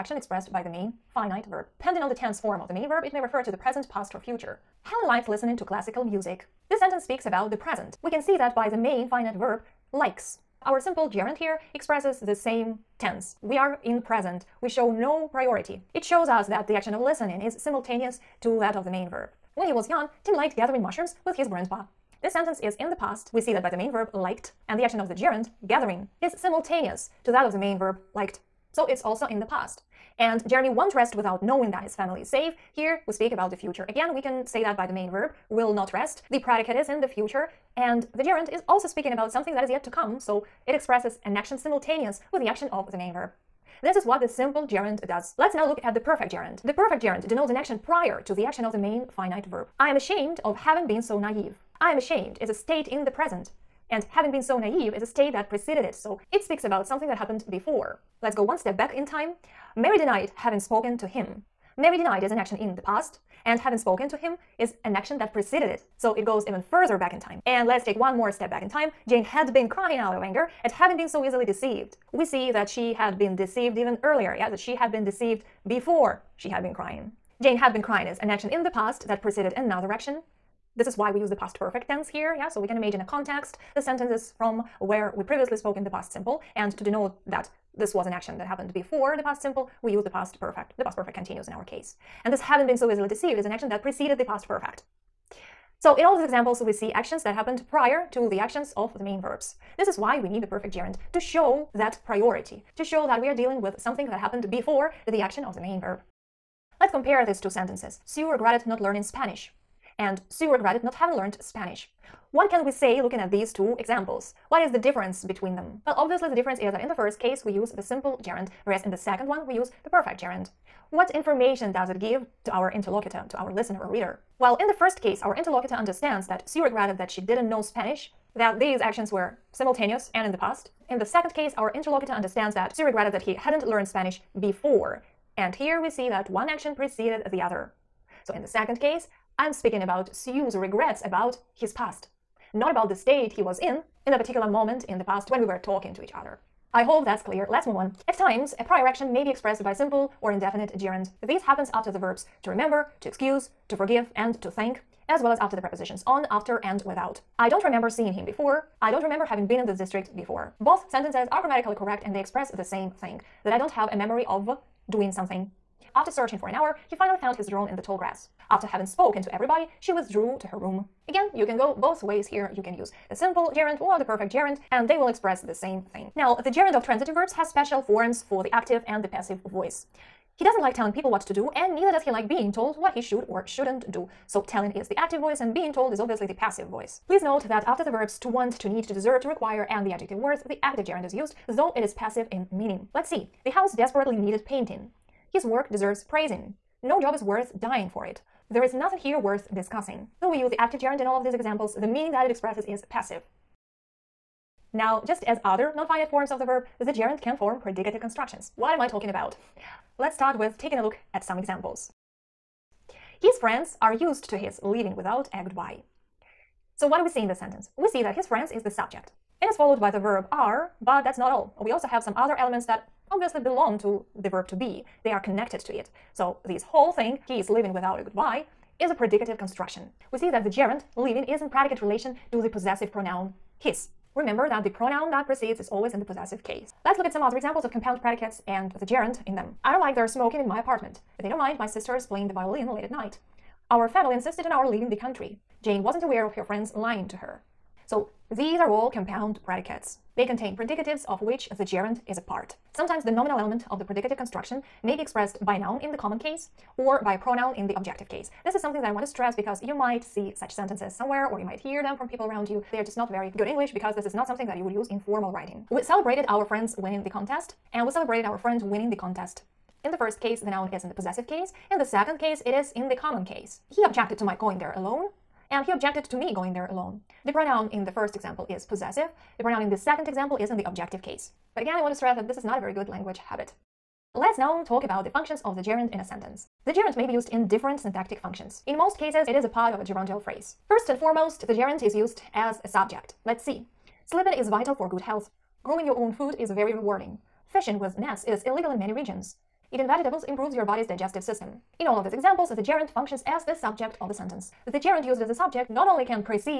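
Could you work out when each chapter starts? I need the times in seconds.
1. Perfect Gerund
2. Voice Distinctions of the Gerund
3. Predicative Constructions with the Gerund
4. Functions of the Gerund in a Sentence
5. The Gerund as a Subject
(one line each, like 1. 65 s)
1. 45 s
2. 176 s
3. 205 s
4. 284 s
5. 292 s.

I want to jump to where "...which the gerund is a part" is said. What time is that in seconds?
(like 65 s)
251 s.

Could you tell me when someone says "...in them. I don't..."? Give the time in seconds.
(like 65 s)
239 s.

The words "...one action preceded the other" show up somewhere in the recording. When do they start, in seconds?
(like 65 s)
136 s.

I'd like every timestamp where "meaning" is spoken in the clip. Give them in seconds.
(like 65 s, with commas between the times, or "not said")
192 s, 201 s.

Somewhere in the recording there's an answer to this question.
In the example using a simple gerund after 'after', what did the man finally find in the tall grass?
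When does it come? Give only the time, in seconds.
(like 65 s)
167 s.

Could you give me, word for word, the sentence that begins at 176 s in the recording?
Now, the gerund of transitive verbs has special forms for the active and the passive voice.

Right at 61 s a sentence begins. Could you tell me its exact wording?
Mary denied is an action in the past, and having spoken to him is an action that preceded it.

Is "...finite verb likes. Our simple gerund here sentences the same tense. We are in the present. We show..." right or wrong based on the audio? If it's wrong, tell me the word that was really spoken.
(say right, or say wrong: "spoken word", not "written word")
wrong: "expresses", not "sentences".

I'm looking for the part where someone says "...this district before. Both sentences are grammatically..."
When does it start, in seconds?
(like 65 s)
159 s.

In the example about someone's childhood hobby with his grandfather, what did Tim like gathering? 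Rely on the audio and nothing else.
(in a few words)
mushrooms.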